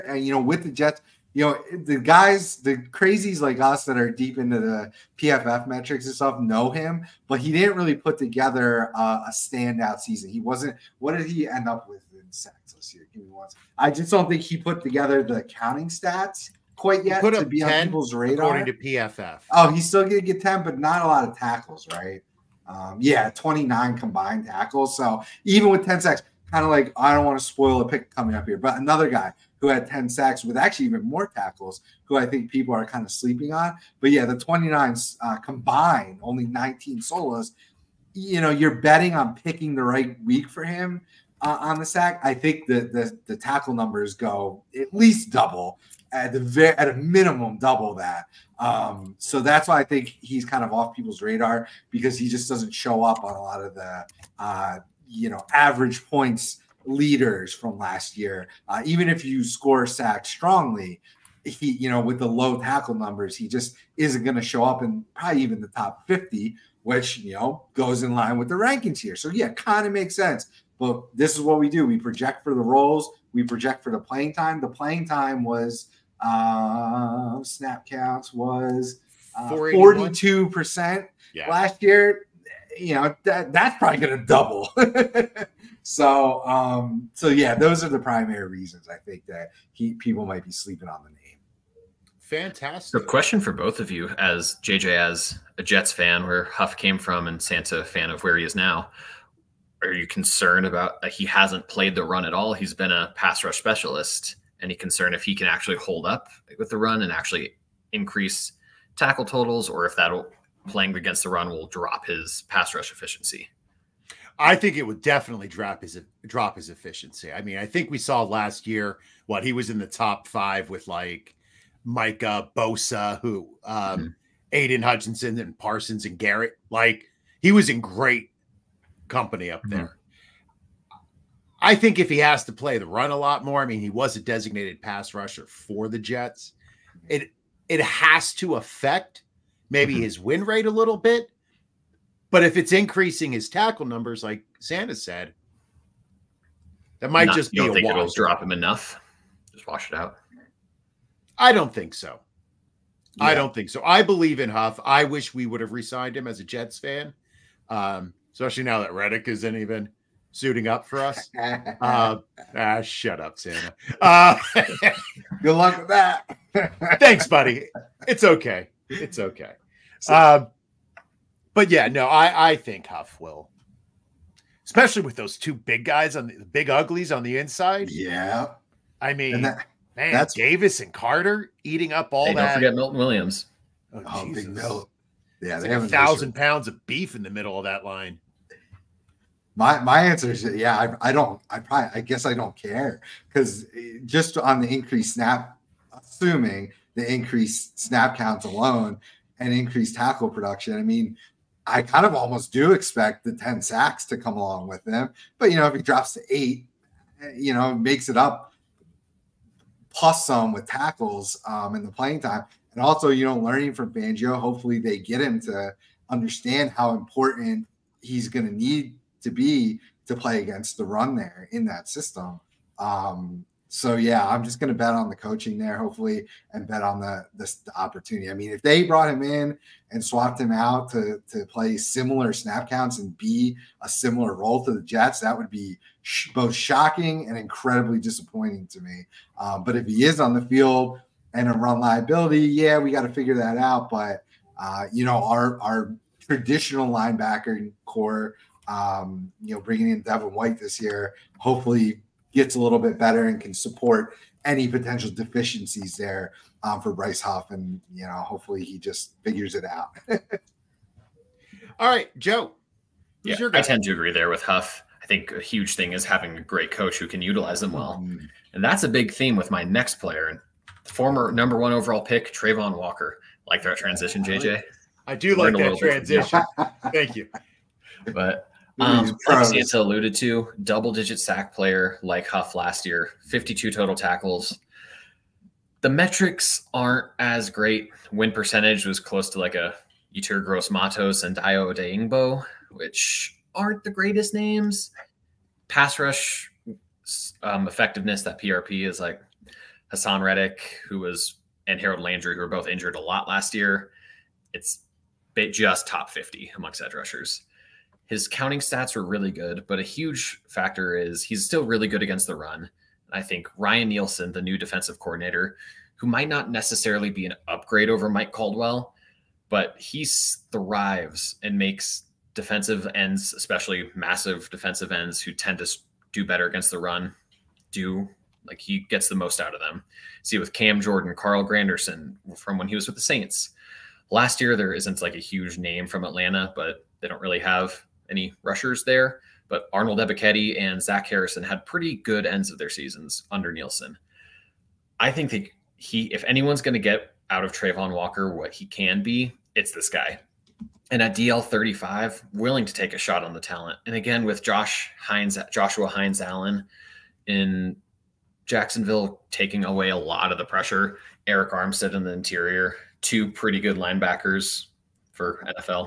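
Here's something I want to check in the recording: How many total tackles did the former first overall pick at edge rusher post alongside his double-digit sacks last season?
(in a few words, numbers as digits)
52.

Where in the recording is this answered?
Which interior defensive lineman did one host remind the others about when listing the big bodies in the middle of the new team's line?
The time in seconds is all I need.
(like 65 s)
182 s.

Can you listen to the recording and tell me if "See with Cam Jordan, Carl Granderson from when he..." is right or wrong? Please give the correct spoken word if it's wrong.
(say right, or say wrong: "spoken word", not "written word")
right.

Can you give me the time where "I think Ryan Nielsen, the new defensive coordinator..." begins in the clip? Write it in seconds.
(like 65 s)
313 s.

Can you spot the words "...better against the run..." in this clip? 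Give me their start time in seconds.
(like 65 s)
326 s.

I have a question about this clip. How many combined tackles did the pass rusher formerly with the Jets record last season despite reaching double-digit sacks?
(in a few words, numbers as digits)
29.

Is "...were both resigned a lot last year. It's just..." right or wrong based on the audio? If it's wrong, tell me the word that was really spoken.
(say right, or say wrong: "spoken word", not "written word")
wrong: "injured", not "resigned".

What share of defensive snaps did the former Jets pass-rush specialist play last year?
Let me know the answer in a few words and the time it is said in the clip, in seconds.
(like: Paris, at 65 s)
42 percent, at 79 s.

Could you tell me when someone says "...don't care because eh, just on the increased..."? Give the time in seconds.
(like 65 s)
192 s.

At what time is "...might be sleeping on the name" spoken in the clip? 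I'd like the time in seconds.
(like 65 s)
90 s.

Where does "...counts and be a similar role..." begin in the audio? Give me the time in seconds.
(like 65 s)
232 s.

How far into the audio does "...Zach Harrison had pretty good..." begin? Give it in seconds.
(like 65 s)
340 s.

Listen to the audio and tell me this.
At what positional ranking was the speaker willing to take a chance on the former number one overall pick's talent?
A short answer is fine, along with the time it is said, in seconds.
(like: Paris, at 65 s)
DL 35, at 351 s.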